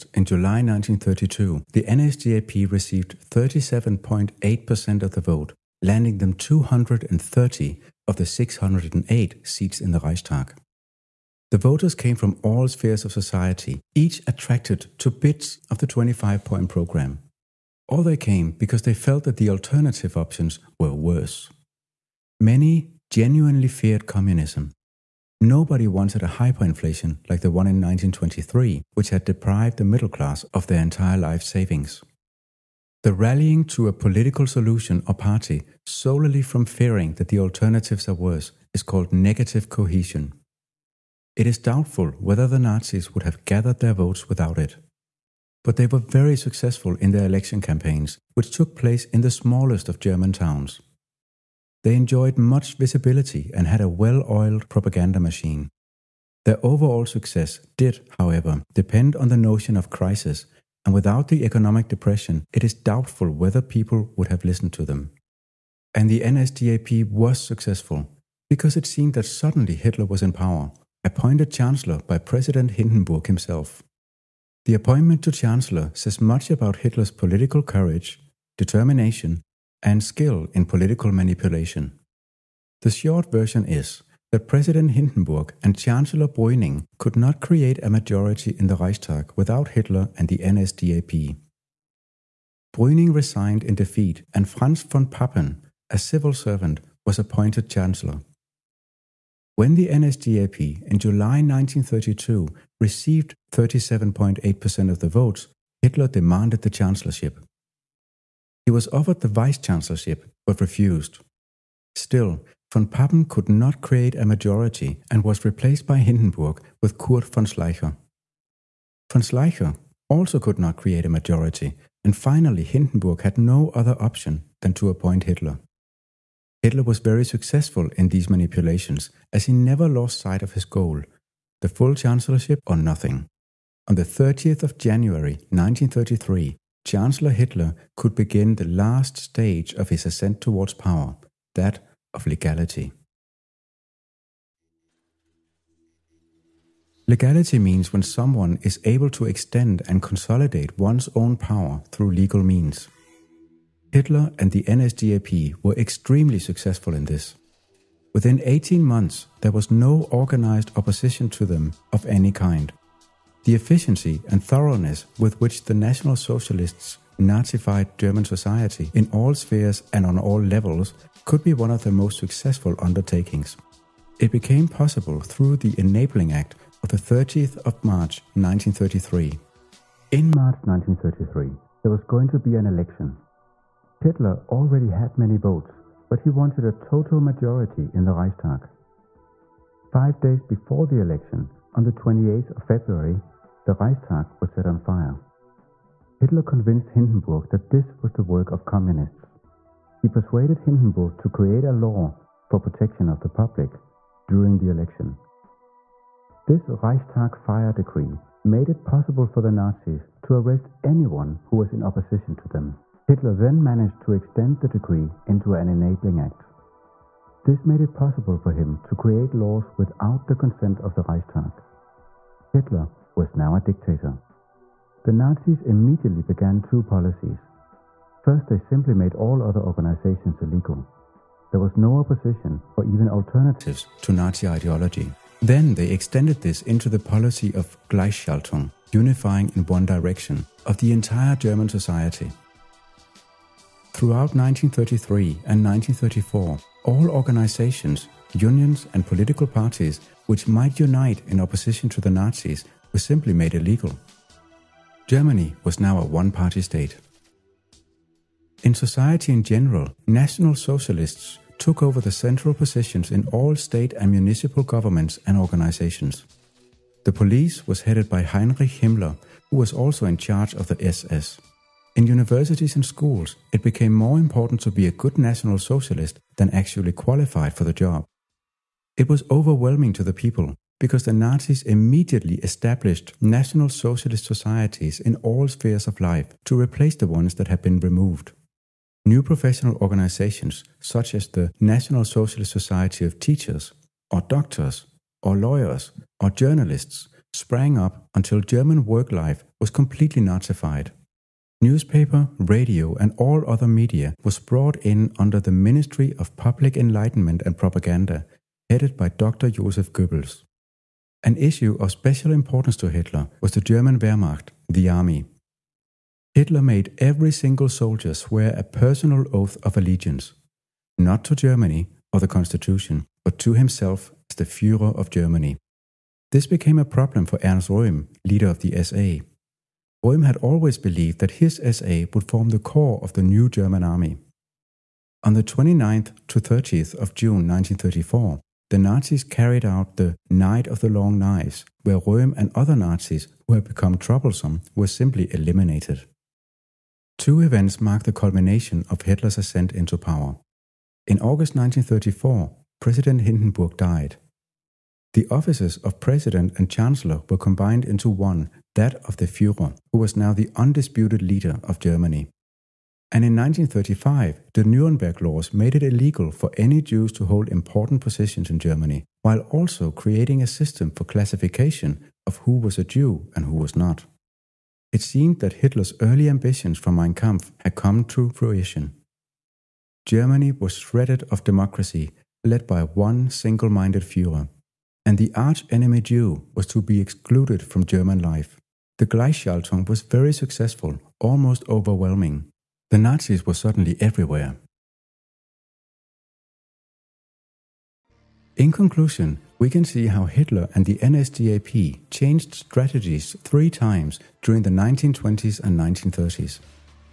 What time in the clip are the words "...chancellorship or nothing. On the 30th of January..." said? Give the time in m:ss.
2:11.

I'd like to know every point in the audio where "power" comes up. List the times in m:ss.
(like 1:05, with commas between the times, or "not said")
1:10, 2:20, 2:31, 5:49.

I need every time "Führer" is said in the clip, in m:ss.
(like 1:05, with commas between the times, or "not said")
5:59.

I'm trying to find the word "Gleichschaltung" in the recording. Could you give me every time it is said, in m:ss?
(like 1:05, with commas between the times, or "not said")
3:57, 6:29.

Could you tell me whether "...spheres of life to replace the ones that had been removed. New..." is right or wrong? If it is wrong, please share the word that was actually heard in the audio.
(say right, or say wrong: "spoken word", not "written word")
right.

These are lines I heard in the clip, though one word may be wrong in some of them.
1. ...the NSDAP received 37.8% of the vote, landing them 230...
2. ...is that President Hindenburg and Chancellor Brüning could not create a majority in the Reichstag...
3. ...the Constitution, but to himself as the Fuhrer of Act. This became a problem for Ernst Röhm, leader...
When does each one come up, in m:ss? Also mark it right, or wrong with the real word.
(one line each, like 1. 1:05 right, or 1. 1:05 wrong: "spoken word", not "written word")
1. 0:01 right
2. 1:23 right
3. 5:22 wrong: "Germany", not "Act".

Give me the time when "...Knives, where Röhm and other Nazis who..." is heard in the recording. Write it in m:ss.
5:41.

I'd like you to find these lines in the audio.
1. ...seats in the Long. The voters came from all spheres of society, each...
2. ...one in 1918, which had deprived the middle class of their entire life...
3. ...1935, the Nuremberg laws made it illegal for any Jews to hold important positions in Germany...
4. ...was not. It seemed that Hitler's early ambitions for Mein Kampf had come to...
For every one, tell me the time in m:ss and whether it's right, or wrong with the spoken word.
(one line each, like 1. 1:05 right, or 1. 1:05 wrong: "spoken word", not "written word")
1. 0:09 wrong: "Reichstag", not "Long"
2. 0:27 wrong: "1923", not "1918"
3. 6:03 right
4. 6:13 right.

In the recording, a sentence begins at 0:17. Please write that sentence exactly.
Or they came because they felt that the alternative options were worse.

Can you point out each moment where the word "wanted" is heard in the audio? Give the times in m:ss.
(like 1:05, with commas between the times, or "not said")
0:25, 3:06.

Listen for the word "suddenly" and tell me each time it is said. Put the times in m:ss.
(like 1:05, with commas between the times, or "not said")
1:09, 6:33.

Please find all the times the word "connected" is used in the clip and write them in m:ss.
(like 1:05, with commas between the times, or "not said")
not said.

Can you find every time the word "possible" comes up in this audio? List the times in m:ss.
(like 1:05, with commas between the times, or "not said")
2:54, 3:28, 3:37.